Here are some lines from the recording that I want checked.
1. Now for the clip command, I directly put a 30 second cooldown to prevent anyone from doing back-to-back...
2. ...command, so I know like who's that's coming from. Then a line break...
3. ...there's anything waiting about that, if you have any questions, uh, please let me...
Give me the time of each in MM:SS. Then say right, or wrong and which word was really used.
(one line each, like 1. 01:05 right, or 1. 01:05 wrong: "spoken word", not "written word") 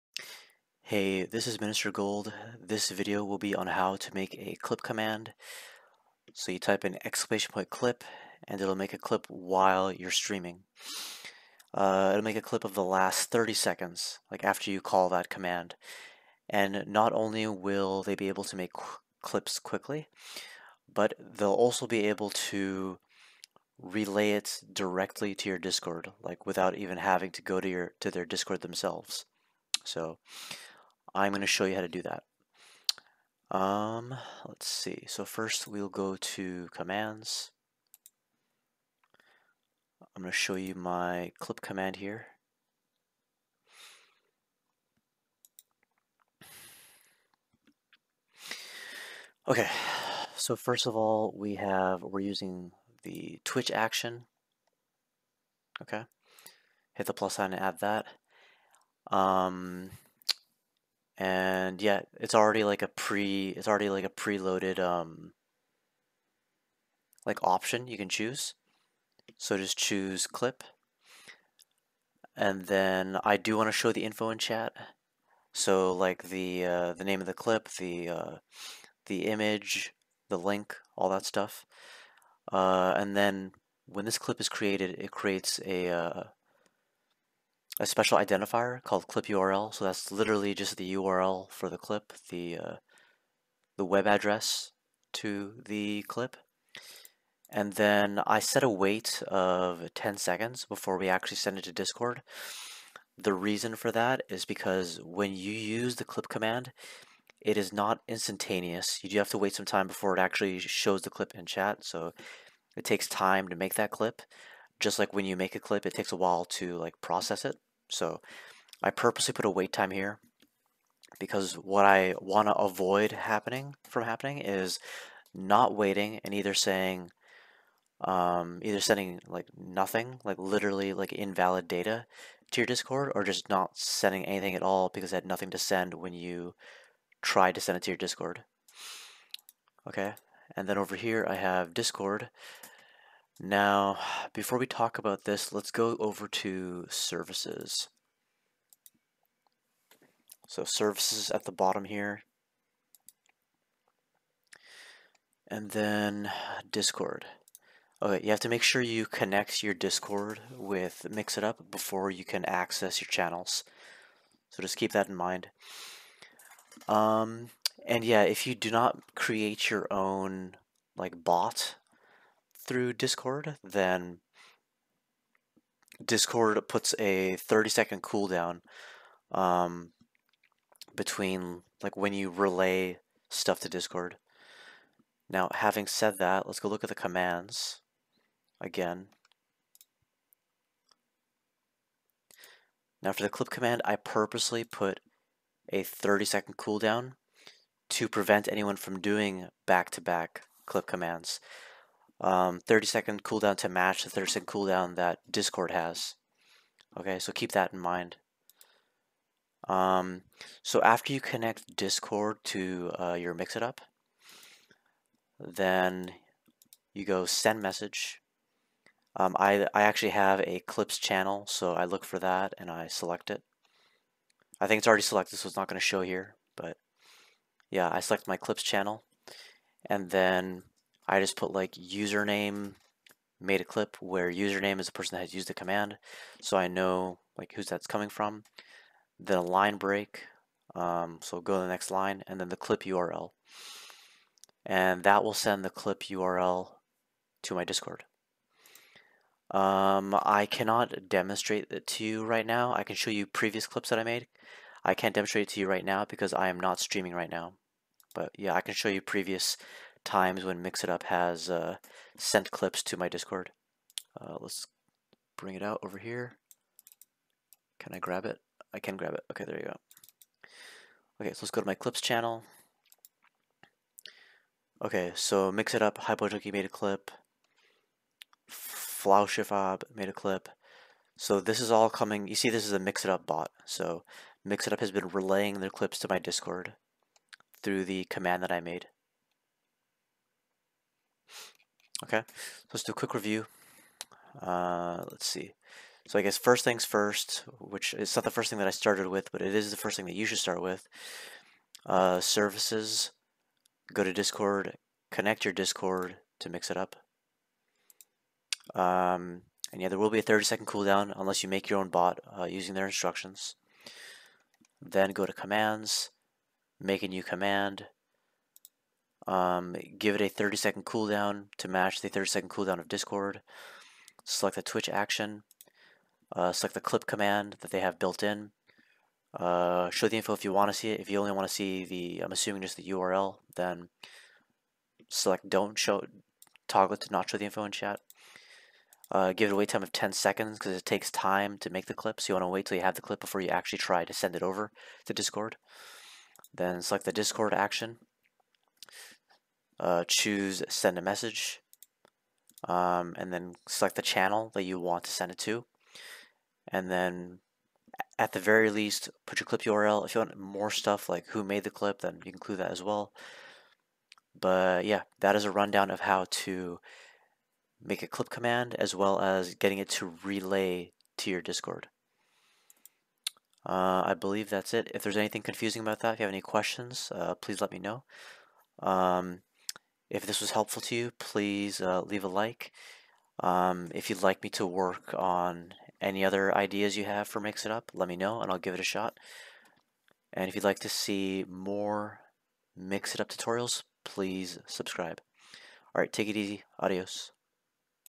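1. 03:13 wrong: "purposely", not "directly"
2. 03:55 right
3. 06:15 wrong: "confusing", not "waiting".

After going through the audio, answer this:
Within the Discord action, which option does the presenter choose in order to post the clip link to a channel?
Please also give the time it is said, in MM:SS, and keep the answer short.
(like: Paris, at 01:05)
send a message, at 05:50.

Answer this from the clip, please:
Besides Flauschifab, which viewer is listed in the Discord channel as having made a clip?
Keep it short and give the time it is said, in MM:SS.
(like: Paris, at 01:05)
Hypo Junkie, at 04:35.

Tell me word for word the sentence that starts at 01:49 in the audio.
You do have to wait some time before it actually shows the clip in chat.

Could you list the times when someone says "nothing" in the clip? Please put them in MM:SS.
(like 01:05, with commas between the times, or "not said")
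02:09, 02:15.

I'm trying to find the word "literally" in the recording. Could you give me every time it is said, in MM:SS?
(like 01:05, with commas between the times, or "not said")
01:30, 02:10.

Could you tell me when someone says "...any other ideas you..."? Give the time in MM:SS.
06:26.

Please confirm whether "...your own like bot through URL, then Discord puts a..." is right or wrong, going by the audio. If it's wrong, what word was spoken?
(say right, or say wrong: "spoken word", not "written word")
wrong: "Discord", not "URL".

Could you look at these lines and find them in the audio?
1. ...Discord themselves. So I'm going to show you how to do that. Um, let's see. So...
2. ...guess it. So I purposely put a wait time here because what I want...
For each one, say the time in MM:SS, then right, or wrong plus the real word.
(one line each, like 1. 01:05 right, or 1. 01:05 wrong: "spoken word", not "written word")
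1. 00:28 right
2. 01:57 wrong: "process", not "guess".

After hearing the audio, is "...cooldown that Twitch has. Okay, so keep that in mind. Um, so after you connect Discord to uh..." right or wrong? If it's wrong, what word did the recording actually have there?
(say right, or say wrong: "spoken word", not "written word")
wrong: "Discord", not "Twitch".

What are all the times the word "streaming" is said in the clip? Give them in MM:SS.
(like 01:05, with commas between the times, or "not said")
00:10, 04:16.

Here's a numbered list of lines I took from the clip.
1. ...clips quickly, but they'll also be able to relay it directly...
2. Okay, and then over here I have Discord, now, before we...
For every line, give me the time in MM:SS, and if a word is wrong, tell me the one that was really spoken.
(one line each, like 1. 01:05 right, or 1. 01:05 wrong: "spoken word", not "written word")
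1. 00:19 right
2. 02:19 right.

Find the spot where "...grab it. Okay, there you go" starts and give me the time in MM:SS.
04:28.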